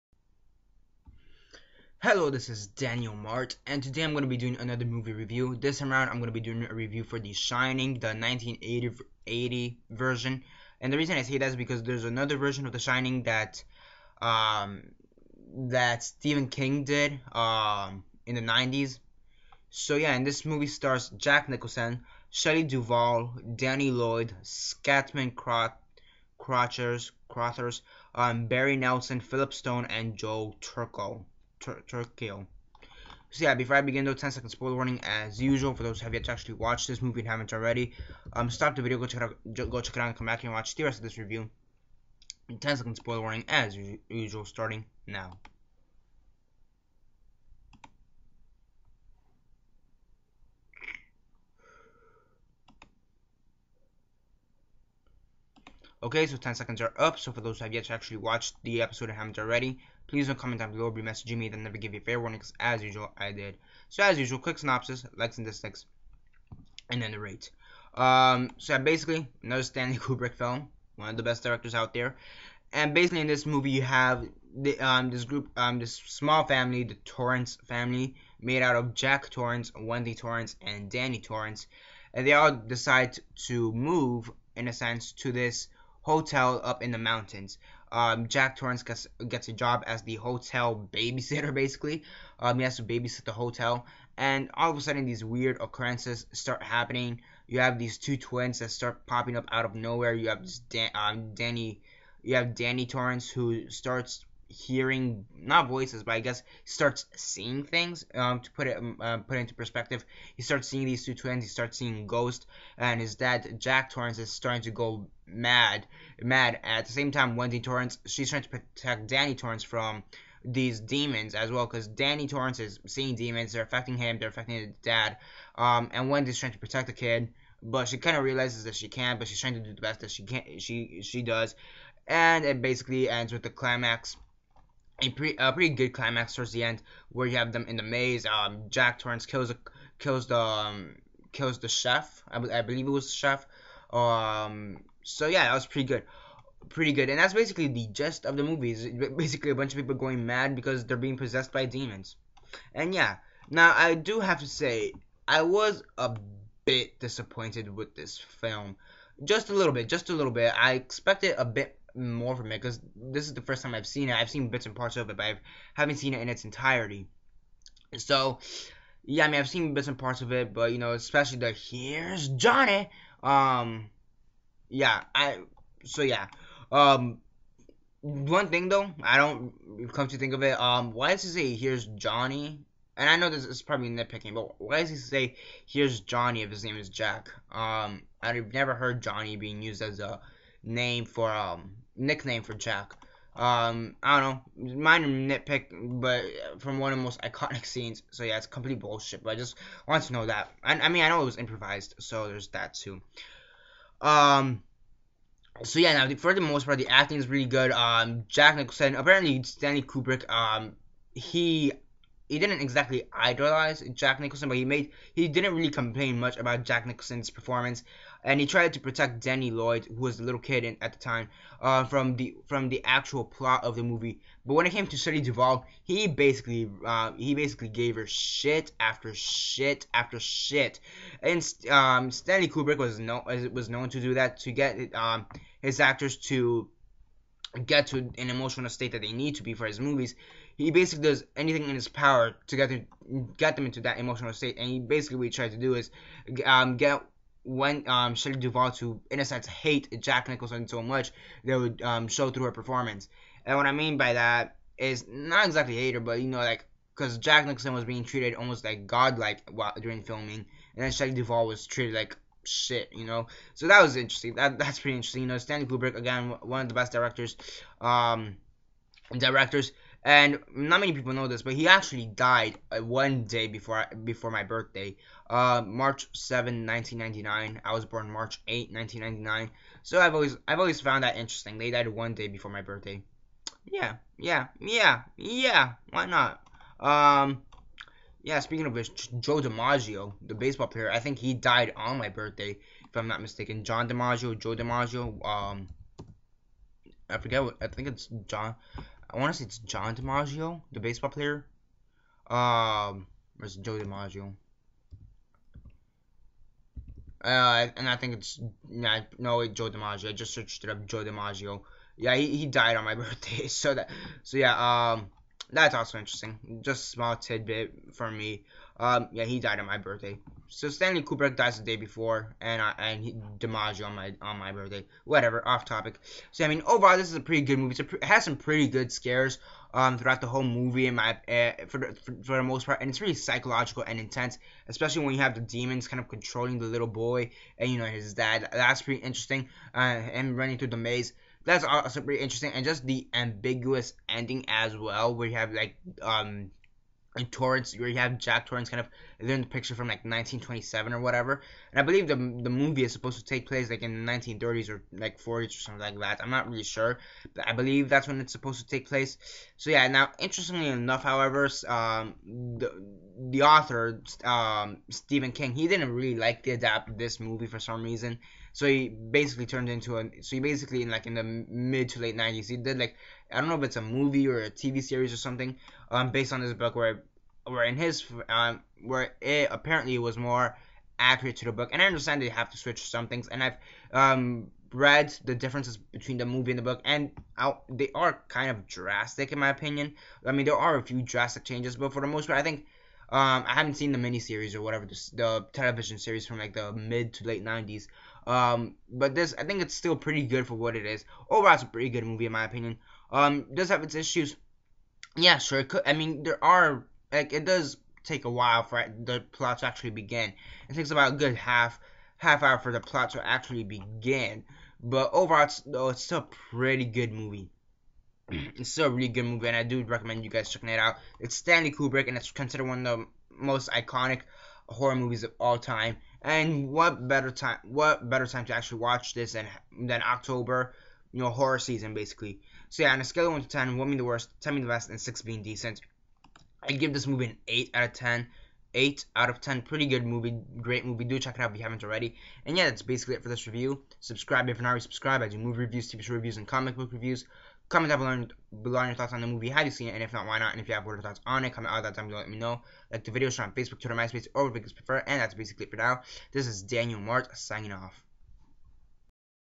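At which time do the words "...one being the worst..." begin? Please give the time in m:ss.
7:13.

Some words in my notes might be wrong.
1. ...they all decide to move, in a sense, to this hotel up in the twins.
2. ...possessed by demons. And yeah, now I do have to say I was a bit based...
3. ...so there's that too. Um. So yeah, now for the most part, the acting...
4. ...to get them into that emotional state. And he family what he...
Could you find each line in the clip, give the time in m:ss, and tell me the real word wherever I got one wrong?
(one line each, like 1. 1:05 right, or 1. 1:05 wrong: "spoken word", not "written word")
1. 1:22 wrong: "mountains", not "twins"
2. 2:31 wrong: "disappointed", not "based"
3. 3:21 right
4. 4:02 wrong: "basically", not "family".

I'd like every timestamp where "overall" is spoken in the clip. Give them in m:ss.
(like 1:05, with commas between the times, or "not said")
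5:26, 6:41, 6:55.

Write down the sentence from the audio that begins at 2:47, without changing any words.
So, yeah, I mean, I've seen bits and parts of it, but you know, especially the here's Johnny.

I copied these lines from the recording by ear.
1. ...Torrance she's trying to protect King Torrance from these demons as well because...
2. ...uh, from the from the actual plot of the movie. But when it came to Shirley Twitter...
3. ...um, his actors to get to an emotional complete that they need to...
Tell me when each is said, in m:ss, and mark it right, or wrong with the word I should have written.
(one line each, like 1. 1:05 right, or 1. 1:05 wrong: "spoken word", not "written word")
1. 1:57 wrong: "Danny", not "King"
2. 3:41 wrong: "Duvall", not "Twitter"
3. 3:54 wrong: "state", not "complete".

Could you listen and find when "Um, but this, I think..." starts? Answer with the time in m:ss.
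6:38.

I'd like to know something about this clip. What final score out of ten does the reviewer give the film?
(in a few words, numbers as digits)
8.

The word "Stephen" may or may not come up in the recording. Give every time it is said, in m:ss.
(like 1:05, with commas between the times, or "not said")
0:16, 6:04.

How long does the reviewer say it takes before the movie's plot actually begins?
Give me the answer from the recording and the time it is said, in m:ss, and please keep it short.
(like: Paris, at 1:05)
half hour, at 6:52.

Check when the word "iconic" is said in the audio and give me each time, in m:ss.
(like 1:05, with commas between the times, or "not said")
3:17, 7:03.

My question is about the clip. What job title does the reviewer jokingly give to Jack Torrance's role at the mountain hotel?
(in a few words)
hotel babysitter.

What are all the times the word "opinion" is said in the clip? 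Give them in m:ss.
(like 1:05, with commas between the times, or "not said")
6:29, 6:42.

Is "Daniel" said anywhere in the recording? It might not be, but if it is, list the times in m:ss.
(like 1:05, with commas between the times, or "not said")
0:02, 7:36.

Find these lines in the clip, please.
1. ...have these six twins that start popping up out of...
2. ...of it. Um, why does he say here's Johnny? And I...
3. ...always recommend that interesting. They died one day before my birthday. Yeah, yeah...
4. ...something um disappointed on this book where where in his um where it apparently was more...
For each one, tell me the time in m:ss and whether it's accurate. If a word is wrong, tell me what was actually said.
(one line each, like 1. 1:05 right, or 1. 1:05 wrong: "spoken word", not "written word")
1. 1:37 wrong: "two", not "six"
2. 3:00 right
3. 4:40 wrong: "found", not "recommend"
4. 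6:15 wrong: "based", not "disappointed".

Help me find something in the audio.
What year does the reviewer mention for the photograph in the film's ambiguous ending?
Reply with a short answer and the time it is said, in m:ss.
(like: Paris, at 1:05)
1927, at 5:50.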